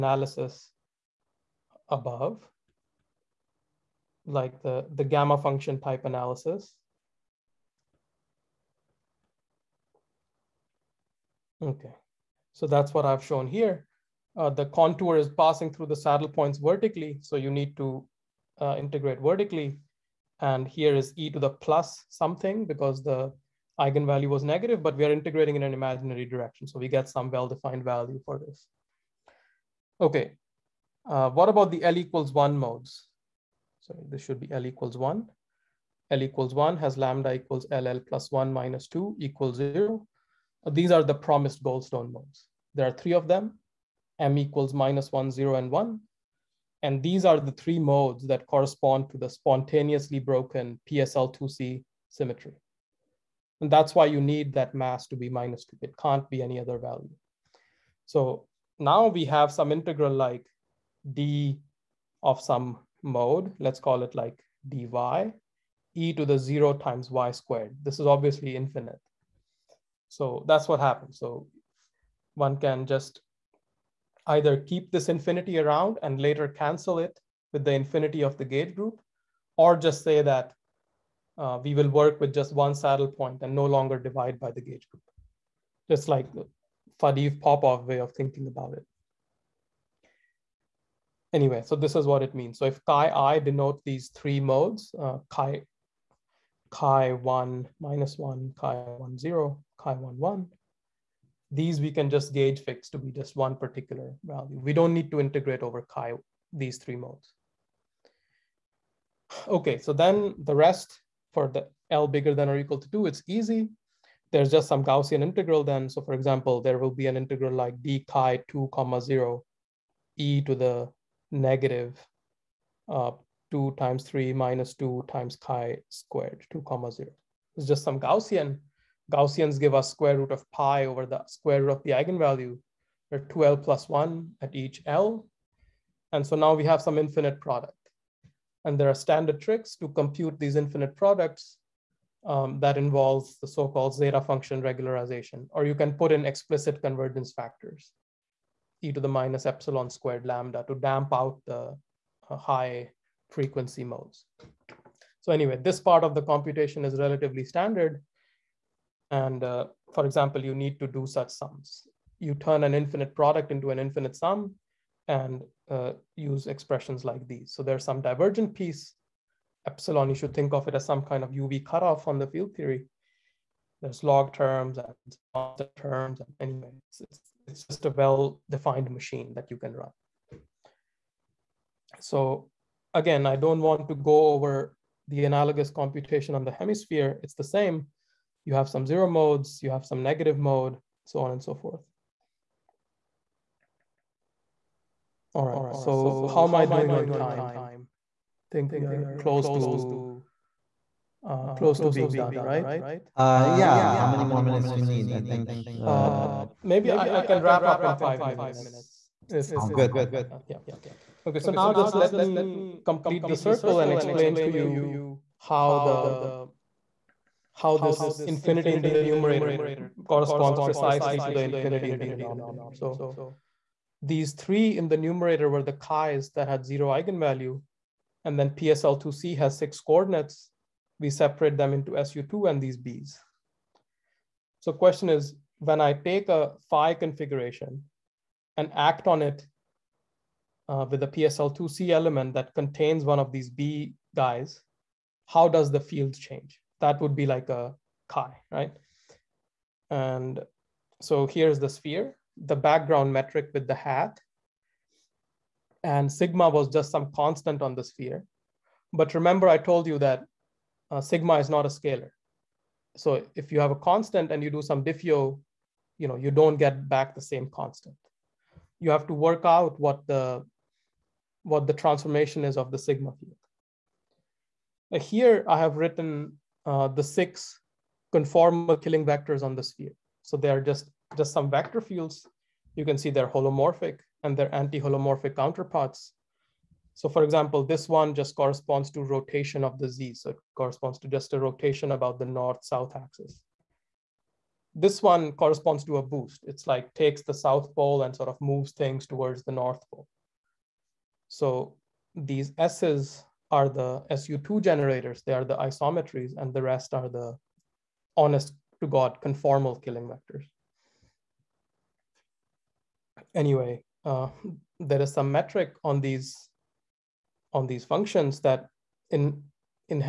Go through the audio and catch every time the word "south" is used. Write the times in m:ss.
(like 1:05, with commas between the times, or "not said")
4:52, 4:57.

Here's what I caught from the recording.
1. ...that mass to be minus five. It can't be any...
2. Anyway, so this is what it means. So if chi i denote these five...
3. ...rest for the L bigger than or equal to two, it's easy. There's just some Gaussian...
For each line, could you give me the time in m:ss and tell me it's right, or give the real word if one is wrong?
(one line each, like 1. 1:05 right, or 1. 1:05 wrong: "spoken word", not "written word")
1. 0:54 wrong: "two", not "five"
2. 1:31 wrong: "three", not "five"
3. 1:50 right.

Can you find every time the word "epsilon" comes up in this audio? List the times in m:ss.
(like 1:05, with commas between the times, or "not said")
2:29, 2:49.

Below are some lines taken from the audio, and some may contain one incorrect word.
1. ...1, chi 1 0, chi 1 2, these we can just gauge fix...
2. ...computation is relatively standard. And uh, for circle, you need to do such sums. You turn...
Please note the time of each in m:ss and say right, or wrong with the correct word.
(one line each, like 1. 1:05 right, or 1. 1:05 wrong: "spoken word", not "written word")
1. 1:38 wrong: "1", not "2"
2. 2:36 wrong: "example", not "circle".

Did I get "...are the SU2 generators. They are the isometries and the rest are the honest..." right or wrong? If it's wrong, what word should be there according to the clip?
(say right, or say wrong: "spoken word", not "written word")
right.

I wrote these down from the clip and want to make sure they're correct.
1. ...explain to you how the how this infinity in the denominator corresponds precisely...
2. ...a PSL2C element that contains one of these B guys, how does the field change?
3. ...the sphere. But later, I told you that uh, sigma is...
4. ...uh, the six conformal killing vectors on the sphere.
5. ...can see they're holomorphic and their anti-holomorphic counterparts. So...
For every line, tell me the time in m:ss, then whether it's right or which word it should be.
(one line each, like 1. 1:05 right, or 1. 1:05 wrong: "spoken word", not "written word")
1. 3:33 wrong: "numerator", not "denominator"
2. 4:01 right
3. 4:17 wrong: "remember", not "later"
4. 4:36 right
5. 4:42 right.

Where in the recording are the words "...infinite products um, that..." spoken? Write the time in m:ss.
2:20.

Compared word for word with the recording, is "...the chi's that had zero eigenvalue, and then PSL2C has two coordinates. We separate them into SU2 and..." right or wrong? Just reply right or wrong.
wrong.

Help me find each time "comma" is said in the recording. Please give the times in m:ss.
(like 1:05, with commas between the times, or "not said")
1:58, 2:06.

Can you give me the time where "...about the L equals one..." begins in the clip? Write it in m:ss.
0:31.